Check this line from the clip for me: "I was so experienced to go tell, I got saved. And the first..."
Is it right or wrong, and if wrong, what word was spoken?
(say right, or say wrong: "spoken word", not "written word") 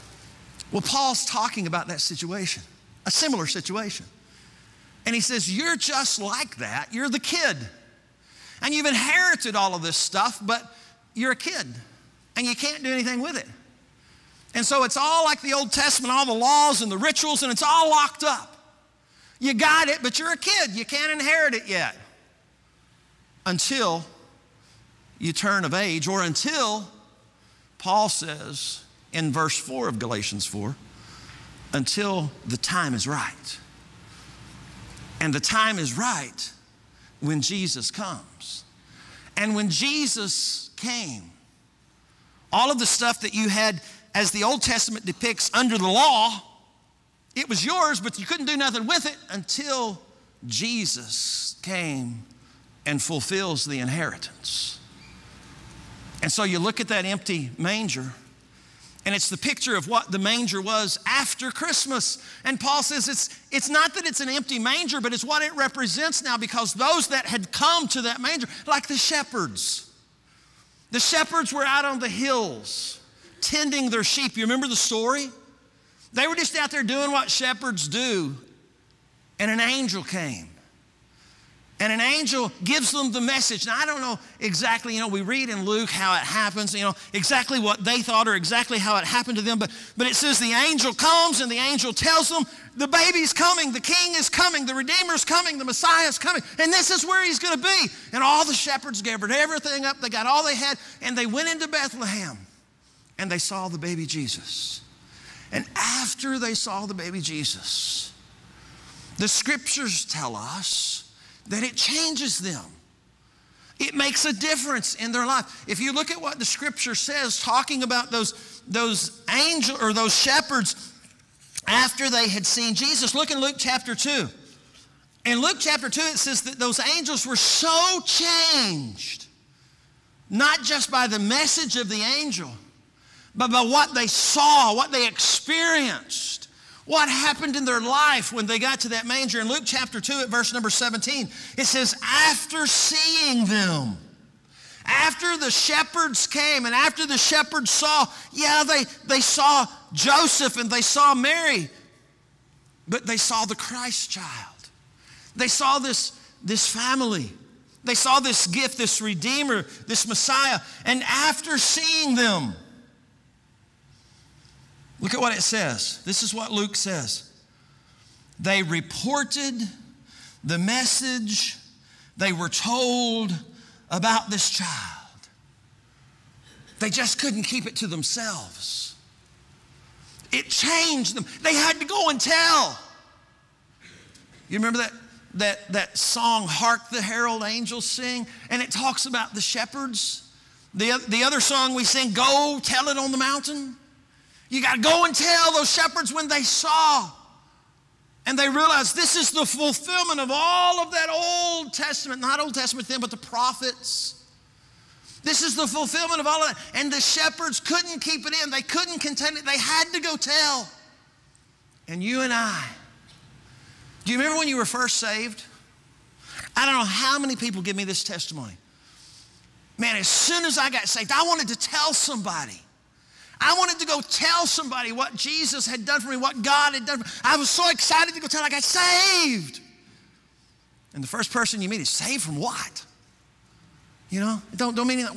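wrong: "excited", not "experienced".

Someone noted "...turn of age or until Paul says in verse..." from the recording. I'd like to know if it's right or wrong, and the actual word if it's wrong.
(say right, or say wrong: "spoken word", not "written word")
right.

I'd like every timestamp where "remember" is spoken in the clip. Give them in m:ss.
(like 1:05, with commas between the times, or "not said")
1:14, 3:04, 3:34.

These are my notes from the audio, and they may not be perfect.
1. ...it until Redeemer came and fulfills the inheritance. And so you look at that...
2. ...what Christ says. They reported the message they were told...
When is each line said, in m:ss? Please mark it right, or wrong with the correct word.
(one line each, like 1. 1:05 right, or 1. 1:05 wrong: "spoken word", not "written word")
1. 0:49 wrong: "Jesus", not "Redeemer"
2. 2:46 wrong: "Luke", not "Christ".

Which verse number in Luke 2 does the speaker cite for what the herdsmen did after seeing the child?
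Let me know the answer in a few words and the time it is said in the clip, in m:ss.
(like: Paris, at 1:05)
17, at 2:20.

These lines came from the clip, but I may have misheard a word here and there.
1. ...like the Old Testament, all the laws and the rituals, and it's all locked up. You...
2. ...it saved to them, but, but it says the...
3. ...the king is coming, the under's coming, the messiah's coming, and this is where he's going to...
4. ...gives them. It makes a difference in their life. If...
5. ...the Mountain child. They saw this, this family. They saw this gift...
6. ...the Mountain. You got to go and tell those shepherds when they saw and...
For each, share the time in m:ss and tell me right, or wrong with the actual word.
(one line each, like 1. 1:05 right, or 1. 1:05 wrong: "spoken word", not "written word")
1. 0:15 right
2. 1:28 wrong: "happened", not "saved"
3. 1:33 wrong: "redeemer", not "under"
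4. 1:51 wrong: "changes", not "gives"
5. 2:33 wrong: "Christ", not "Mountain"
6. 3:13 right.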